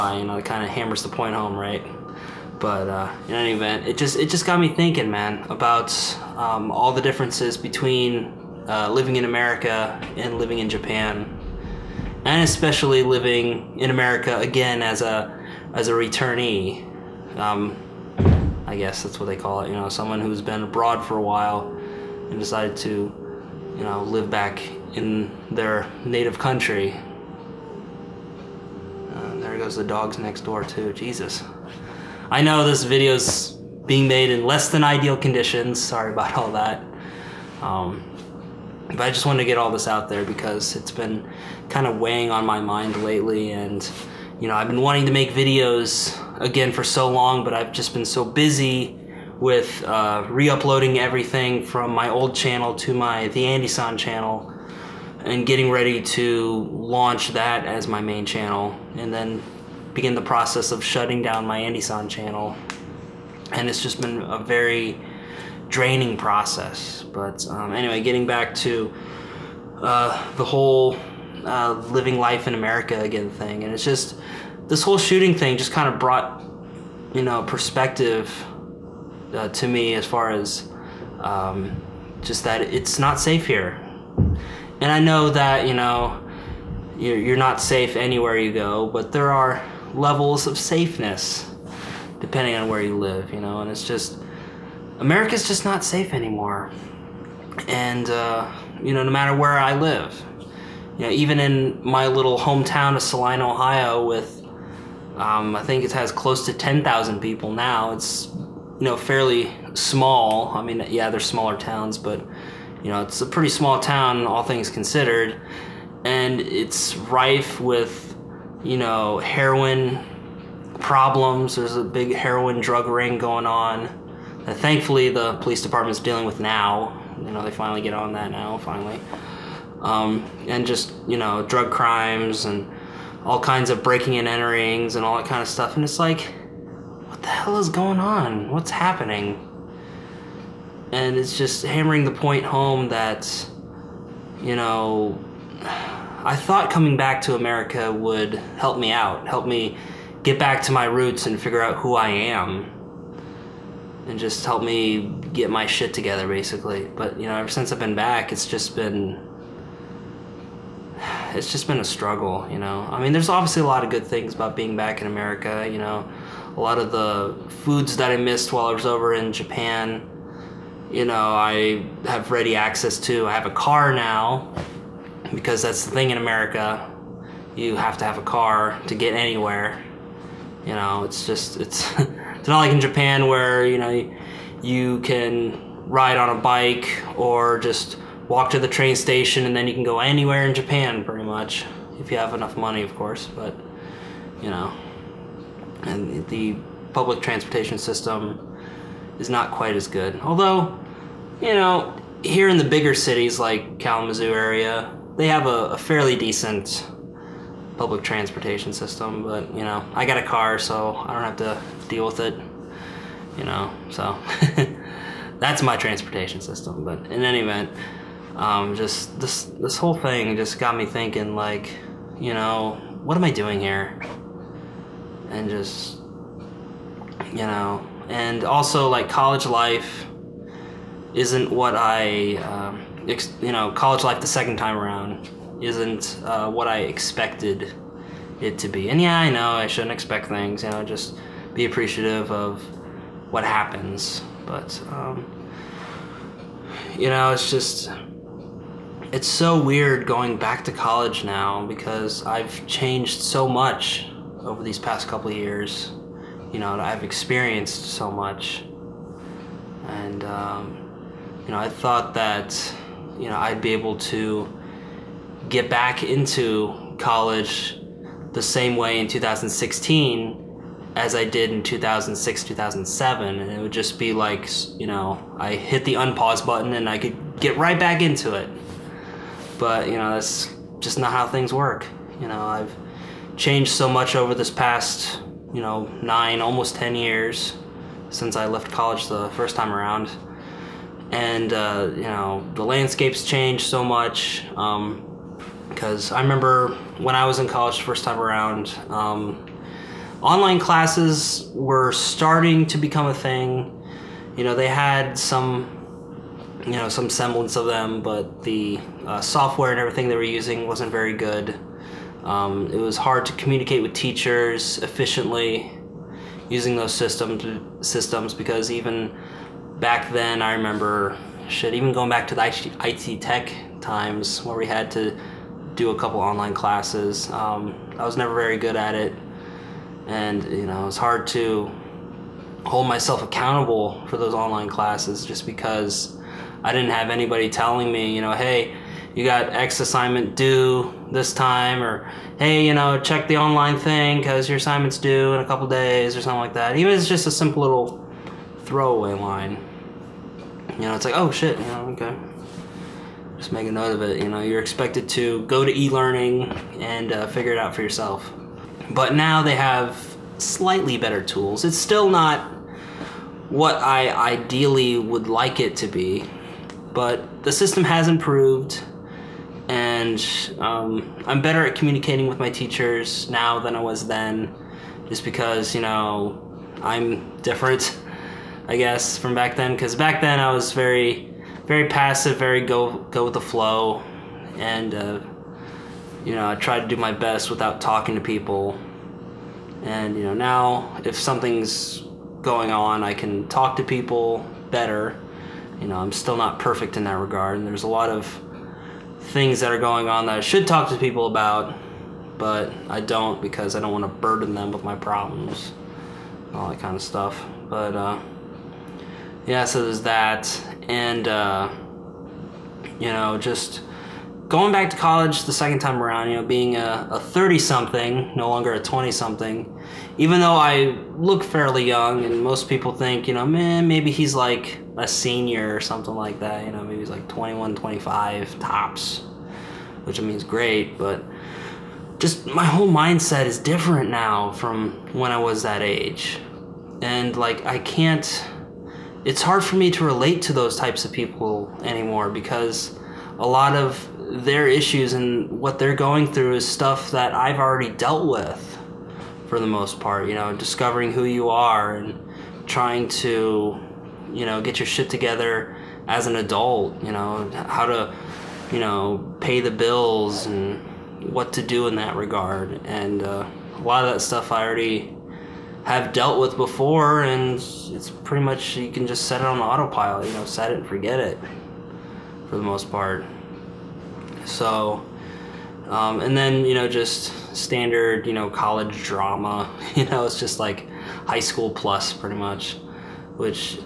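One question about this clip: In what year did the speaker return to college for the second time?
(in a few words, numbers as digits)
2016.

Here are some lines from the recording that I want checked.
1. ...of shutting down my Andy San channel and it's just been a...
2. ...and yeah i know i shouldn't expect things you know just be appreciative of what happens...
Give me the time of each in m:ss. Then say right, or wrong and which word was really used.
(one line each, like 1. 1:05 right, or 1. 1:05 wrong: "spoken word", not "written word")
1. 1:00 right
2. 3:58 right.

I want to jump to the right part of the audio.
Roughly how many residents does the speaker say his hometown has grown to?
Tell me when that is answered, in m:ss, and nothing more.
1:46.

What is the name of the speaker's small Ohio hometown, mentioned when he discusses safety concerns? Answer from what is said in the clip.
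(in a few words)
Saline.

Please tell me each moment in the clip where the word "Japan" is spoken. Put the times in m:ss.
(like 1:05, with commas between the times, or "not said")
0:10, 2:49, 3:02, 3:10.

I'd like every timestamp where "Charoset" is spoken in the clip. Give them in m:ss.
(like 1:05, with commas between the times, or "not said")
not said.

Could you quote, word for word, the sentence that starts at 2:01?
There's a big heroin drug ring going on.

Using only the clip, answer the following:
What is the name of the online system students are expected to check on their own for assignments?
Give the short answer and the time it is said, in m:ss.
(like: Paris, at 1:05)
e learning, at 5:55.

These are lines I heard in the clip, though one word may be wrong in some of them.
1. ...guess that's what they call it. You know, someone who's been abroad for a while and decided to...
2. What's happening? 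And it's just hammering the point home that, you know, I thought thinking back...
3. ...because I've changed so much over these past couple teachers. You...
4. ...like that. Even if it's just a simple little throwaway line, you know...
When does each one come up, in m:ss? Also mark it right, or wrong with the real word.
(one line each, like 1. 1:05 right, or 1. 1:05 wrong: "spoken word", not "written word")
1. 0:18 right
2. 2:18 wrong: "coming", not "thinking"
3. 4:11 wrong: "years", not "teachers"
4. 5:46 right.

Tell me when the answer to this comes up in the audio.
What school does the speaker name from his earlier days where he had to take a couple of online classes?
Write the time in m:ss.
5:22.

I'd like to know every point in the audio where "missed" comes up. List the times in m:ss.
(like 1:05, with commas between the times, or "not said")
2:48.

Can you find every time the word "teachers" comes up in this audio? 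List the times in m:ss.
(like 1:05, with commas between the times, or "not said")
5:13, 6:12.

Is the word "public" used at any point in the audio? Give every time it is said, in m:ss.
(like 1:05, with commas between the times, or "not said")
3:16, 3:27.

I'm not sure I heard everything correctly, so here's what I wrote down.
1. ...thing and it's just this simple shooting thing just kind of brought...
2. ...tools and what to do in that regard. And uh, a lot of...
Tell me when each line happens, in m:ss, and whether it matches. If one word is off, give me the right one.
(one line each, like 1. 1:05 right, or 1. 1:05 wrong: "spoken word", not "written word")
1. 1:13 wrong: "whole", not "simple"
2. 7:39 wrong: "bills", not "tools".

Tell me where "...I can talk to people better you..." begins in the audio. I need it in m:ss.
6:33.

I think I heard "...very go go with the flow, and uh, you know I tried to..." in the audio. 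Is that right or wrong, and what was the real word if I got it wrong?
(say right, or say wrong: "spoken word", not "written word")
right.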